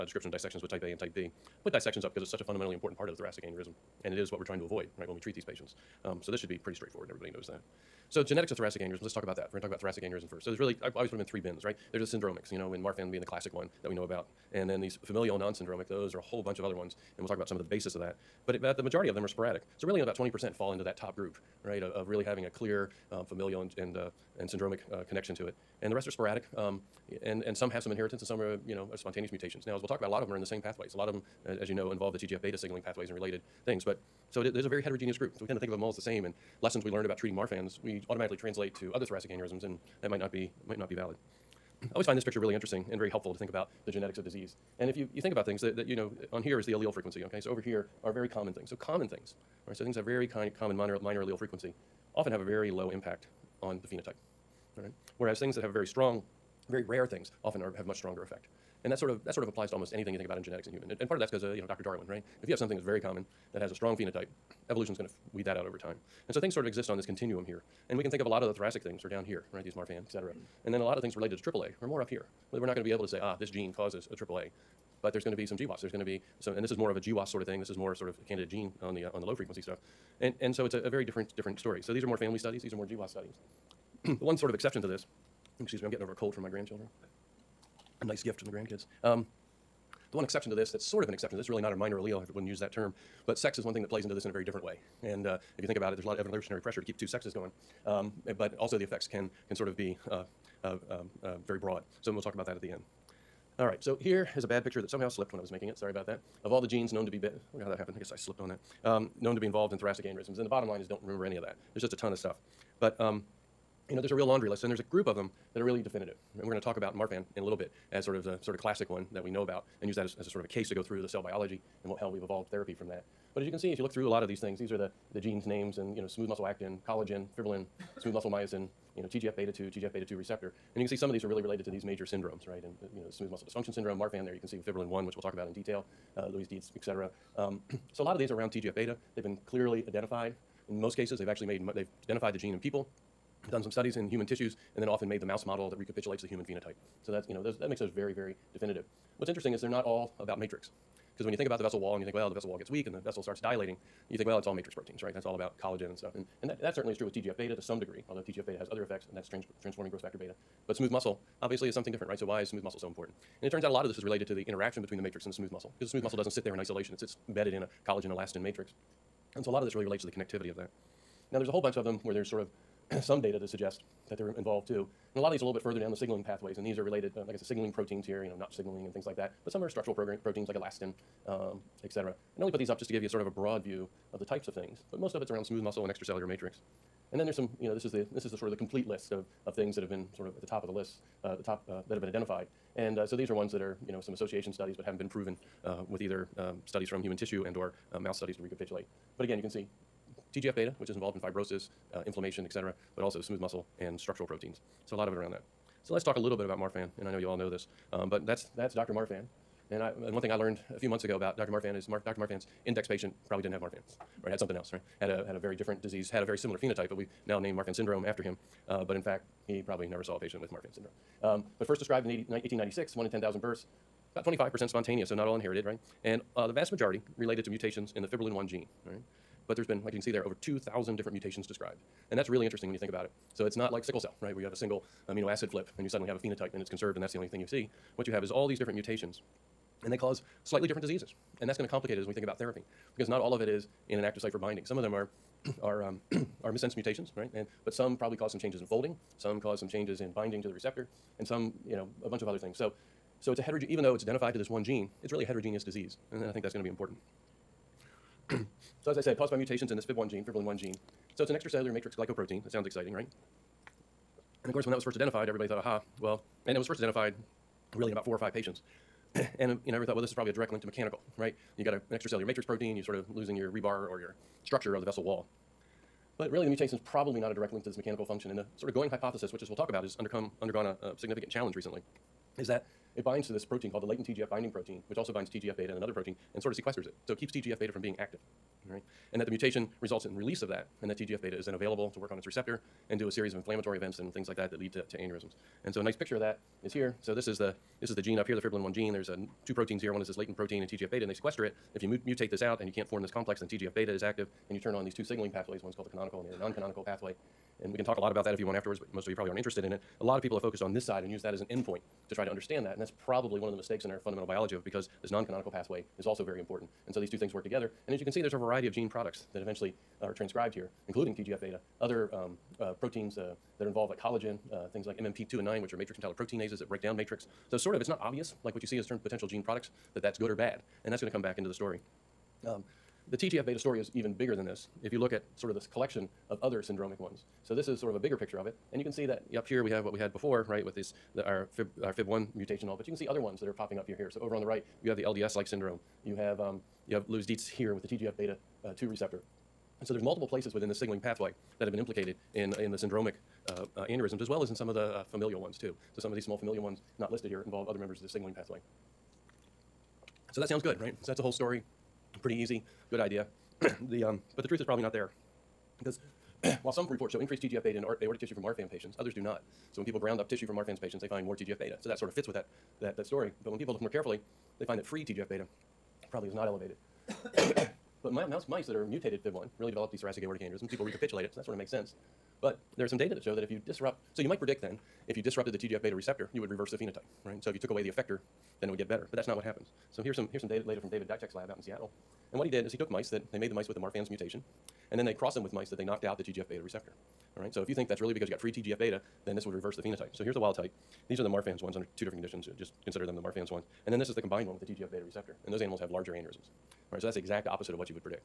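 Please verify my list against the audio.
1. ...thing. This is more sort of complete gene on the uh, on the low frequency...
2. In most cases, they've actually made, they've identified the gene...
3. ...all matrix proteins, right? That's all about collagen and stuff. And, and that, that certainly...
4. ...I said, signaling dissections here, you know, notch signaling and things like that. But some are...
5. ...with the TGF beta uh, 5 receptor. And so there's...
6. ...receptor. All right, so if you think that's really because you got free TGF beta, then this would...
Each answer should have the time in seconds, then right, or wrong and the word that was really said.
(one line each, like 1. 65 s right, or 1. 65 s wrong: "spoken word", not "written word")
1. 77 s wrong: "candidate", not "complete"
2. 140 s right
3. 154 s right
4. 177 s wrong: "proteins", not "dissections"
5. 347 s wrong: "2", not "5"
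6. 396 s right.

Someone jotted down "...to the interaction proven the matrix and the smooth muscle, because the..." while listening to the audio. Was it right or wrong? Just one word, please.
wrong.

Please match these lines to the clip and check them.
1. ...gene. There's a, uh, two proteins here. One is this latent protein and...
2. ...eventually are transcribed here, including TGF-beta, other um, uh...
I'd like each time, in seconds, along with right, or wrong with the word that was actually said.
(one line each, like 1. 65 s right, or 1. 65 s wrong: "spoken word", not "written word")
1. 298 s right
2. 319 s right.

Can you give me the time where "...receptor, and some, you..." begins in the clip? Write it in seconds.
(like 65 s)
250 s.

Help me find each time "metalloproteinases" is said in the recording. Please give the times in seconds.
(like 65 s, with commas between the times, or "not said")
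325 s.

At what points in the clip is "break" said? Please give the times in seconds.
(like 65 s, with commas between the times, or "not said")
326 s.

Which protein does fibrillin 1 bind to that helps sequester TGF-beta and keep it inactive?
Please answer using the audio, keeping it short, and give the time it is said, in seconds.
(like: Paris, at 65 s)
Latent TGF binding protein, at 283 s.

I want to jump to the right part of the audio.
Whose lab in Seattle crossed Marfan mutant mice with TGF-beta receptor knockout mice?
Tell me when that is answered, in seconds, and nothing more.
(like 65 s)
390 s.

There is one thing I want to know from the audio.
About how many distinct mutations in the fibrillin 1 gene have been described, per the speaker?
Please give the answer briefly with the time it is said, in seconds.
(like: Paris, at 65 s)
Over 2,000, at 230 s.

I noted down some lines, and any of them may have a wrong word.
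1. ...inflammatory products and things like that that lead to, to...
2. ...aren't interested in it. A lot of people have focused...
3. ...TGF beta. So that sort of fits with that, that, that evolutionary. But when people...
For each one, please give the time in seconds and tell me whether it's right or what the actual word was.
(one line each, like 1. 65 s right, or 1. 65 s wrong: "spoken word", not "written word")
1. 293 s wrong: "events", not "products"
2. 309 s right
3. 371 s wrong: "story", not "evolutionary".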